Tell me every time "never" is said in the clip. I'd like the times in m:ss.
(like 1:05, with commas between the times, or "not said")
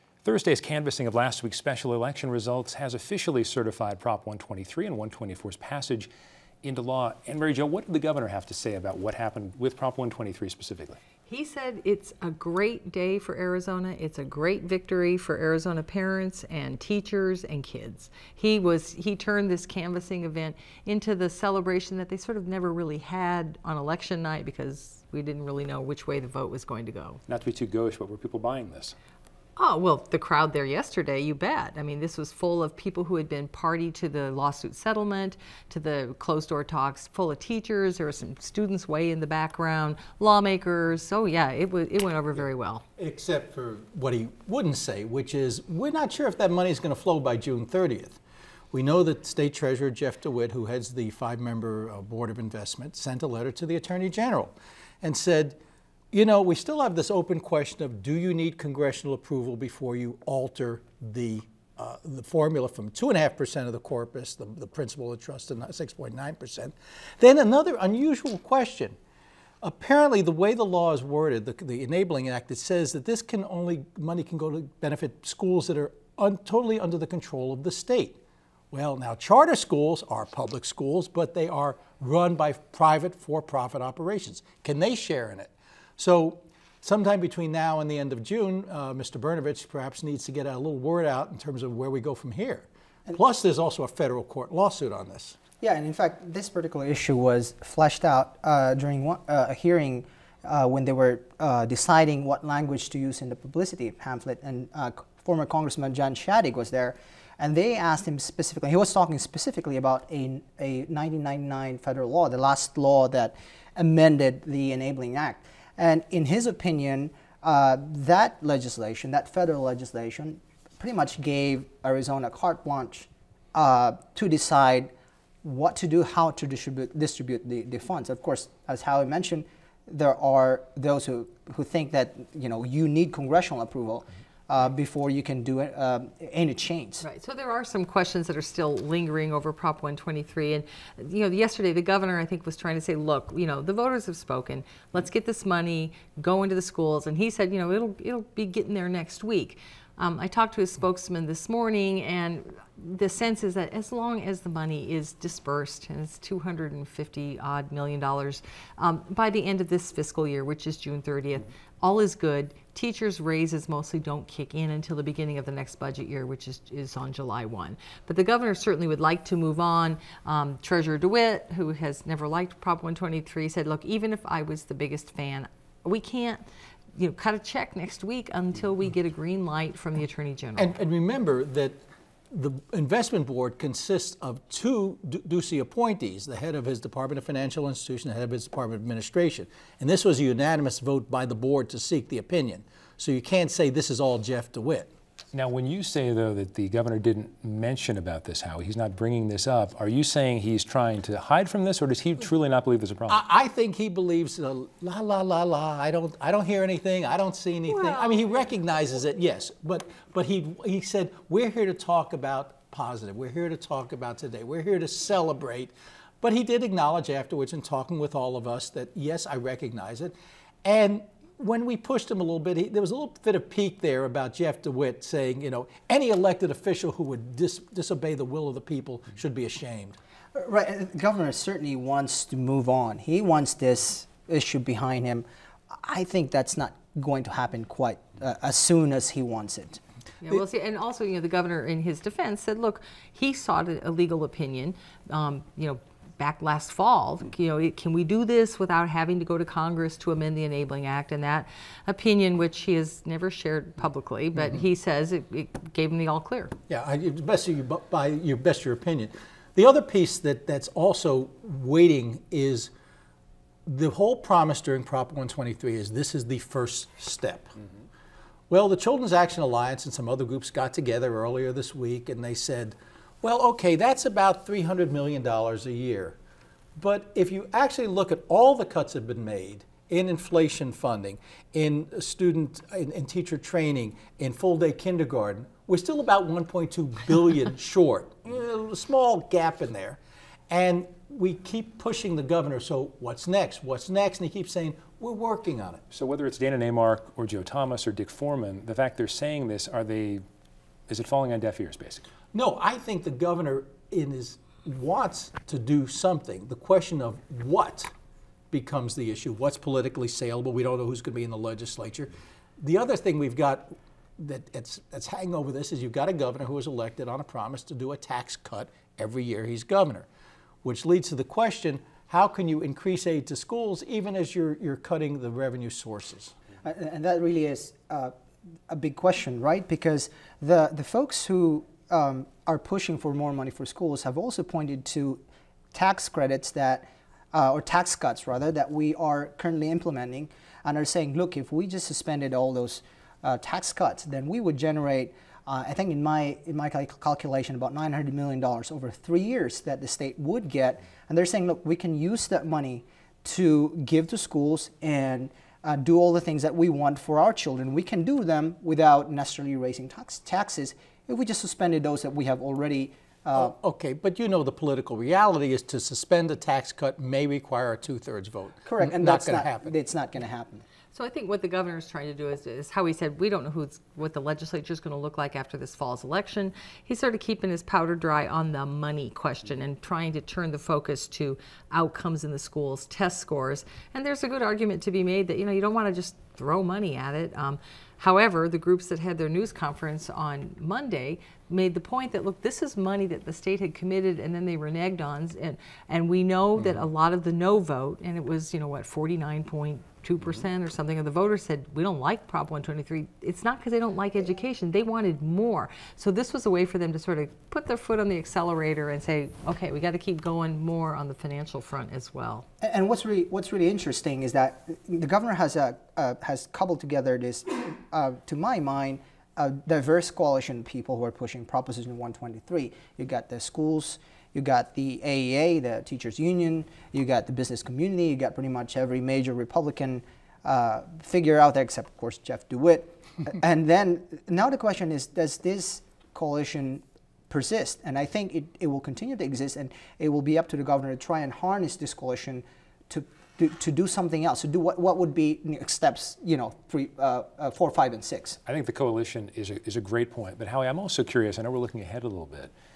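0:22, 2:52, 4:13.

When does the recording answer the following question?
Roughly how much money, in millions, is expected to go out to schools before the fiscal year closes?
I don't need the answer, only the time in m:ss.
2:36.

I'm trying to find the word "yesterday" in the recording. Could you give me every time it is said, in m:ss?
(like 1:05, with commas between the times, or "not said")
0:30, 2:21.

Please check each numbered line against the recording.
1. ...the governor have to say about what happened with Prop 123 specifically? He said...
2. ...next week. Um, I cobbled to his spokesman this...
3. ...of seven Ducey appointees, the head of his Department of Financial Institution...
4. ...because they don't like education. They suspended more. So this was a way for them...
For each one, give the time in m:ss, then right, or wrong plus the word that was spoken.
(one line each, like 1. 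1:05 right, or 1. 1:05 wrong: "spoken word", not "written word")
1. 0:07 right
2. 2:28 wrong: "talked", not "cobbled"
3. 3:04 wrong: "two", not "seven"
4. 6:43 wrong: "wanted", not "suspended".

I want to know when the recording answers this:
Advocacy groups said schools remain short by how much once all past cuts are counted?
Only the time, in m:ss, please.
4:46.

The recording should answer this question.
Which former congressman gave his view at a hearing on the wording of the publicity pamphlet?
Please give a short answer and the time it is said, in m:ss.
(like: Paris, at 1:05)
John Shadegg, at 1:45.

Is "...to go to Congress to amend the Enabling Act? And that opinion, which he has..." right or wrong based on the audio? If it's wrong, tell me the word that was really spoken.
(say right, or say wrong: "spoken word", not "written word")
right.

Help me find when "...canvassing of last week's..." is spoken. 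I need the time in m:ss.
0:00.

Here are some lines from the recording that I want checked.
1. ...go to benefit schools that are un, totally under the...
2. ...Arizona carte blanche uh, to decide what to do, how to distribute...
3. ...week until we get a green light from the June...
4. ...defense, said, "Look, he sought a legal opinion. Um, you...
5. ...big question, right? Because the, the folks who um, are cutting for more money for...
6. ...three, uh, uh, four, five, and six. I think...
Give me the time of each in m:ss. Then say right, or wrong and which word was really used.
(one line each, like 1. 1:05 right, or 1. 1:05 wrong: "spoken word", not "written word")
1. 1:14 right
2. 2:01 right
3. 2:58 wrong: "Attorney", not "June"
4. 4:01 right
5. 5:28 wrong: "pushing", not "cutting"
6. 7:26 right.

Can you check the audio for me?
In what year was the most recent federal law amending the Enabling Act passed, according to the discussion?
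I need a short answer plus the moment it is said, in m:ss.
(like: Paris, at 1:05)
1999, at 1:50.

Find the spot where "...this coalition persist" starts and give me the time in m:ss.
7:15.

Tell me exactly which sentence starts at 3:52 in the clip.
He wants this issue behind him.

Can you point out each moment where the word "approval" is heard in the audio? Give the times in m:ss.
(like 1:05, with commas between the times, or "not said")
0:59, 2:13.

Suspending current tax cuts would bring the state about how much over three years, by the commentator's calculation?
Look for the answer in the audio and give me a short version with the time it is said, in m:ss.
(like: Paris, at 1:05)
$900 million, at 5:47.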